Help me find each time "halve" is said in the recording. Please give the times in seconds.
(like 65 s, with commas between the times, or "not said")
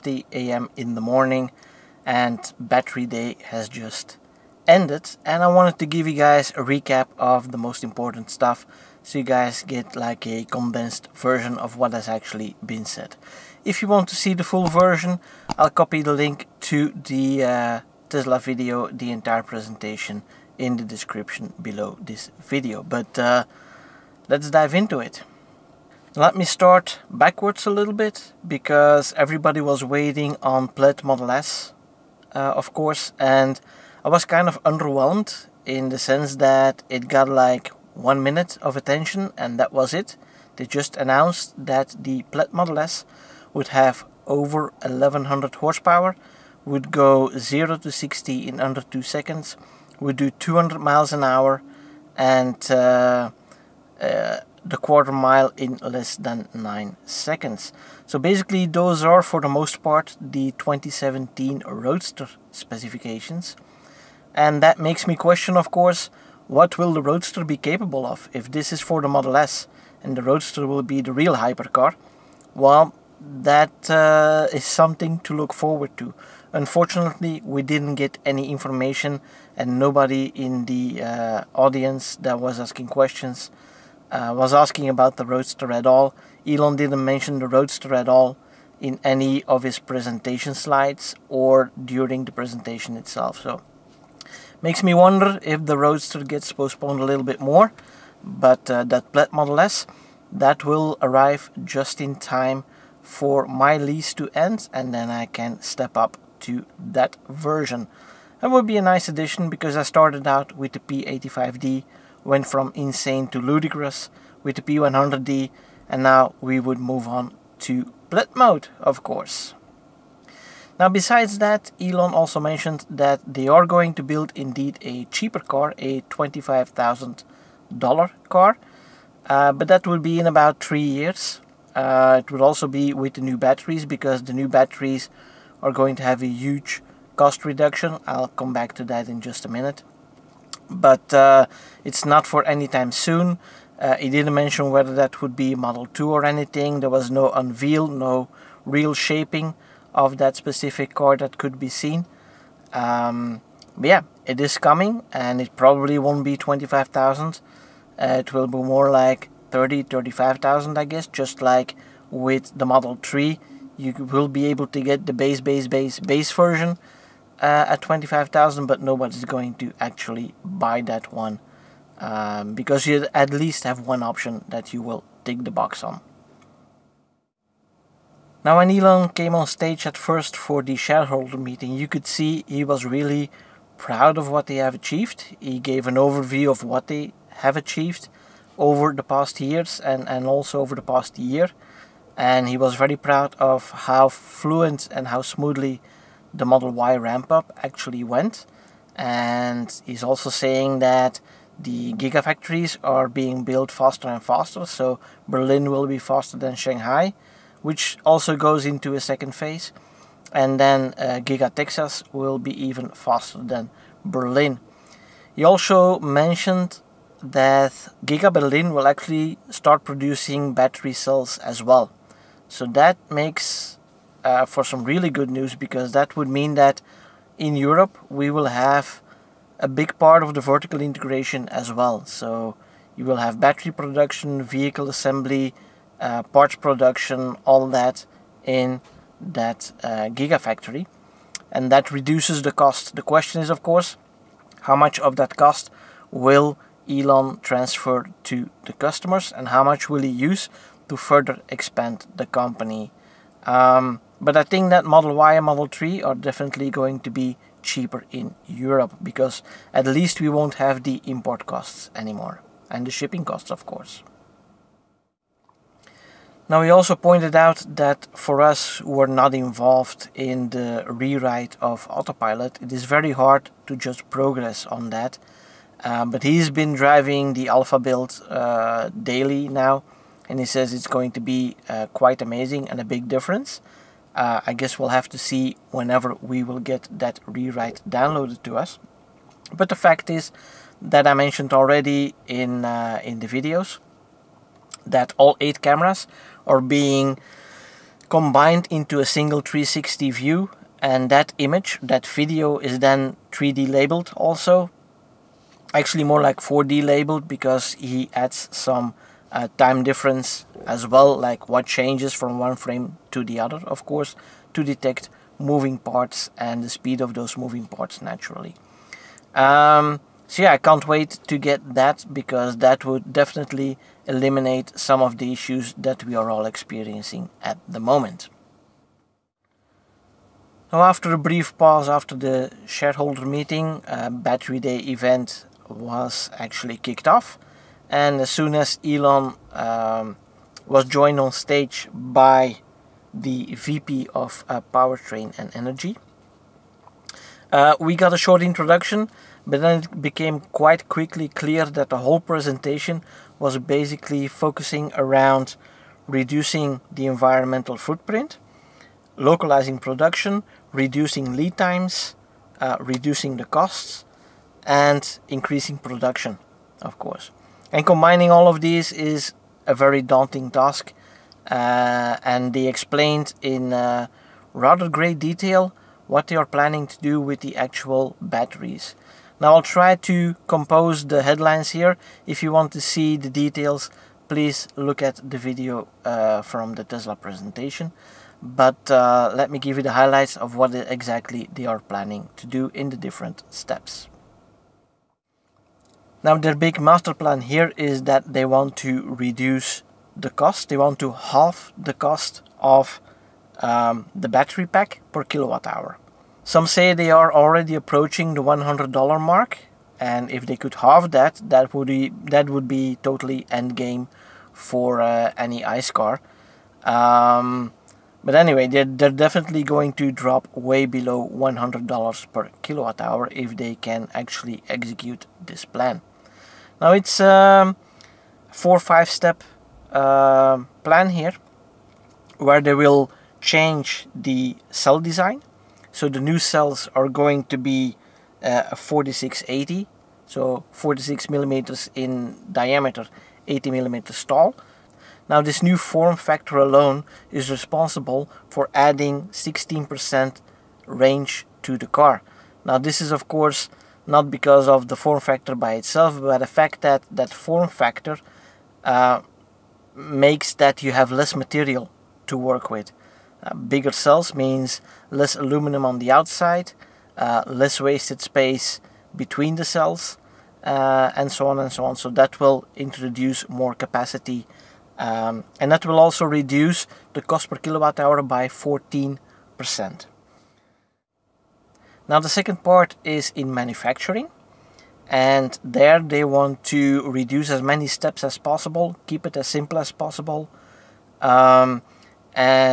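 401 s, 410 s.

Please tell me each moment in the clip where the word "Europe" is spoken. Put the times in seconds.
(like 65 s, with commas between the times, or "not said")
227 s, 258 s.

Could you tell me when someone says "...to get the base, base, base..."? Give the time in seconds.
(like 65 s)
164 s.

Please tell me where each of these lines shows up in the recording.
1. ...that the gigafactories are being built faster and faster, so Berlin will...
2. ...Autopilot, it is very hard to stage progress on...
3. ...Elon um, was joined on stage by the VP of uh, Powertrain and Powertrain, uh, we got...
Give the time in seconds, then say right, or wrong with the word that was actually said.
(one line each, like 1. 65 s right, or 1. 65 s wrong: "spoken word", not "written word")
1. 200 s right
2. 271 s wrong: "judge", not "stage"
3. 338 s wrong: "Energy", not "Powertrain".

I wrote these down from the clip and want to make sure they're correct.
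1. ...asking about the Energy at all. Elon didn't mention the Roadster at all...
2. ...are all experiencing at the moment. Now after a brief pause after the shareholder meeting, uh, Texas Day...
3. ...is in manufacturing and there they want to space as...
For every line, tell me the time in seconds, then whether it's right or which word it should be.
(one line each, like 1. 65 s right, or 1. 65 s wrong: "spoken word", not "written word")
1. 84 s wrong: "Roadster", not "Energy"
2. 326 s wrong: "Battery", not "Texas"
3. 483 s wrong: "reduce", not "space".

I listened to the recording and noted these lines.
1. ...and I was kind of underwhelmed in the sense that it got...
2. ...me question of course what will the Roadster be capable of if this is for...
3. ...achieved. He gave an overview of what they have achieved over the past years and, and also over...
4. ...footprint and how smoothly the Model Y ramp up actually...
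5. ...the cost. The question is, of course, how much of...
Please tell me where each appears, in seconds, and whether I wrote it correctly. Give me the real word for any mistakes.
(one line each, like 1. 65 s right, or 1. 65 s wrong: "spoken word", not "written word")
1. 33 s right
2. 65 s right
3. 184 s right
4. 194 s wrong: "fluent", not "footprint"
5. 242 s right.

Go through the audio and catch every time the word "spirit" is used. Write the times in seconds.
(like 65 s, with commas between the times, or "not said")
not said.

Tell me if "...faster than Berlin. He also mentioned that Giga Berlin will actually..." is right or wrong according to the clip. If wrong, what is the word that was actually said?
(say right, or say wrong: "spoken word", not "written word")
right.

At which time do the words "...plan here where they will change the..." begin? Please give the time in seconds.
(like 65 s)
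430 s.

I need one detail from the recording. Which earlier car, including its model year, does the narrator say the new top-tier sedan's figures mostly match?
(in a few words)
2017 Roadster.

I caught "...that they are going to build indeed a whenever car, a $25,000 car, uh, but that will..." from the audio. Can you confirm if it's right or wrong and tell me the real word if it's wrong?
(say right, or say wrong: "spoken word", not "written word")
wrong: "cheaper", not "whenever".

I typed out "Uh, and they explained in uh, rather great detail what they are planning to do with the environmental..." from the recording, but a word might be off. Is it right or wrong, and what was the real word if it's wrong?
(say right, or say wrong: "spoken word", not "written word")
wrong: "actual", not "environmental".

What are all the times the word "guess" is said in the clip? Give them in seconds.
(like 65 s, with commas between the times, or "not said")
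160 s, 284 s.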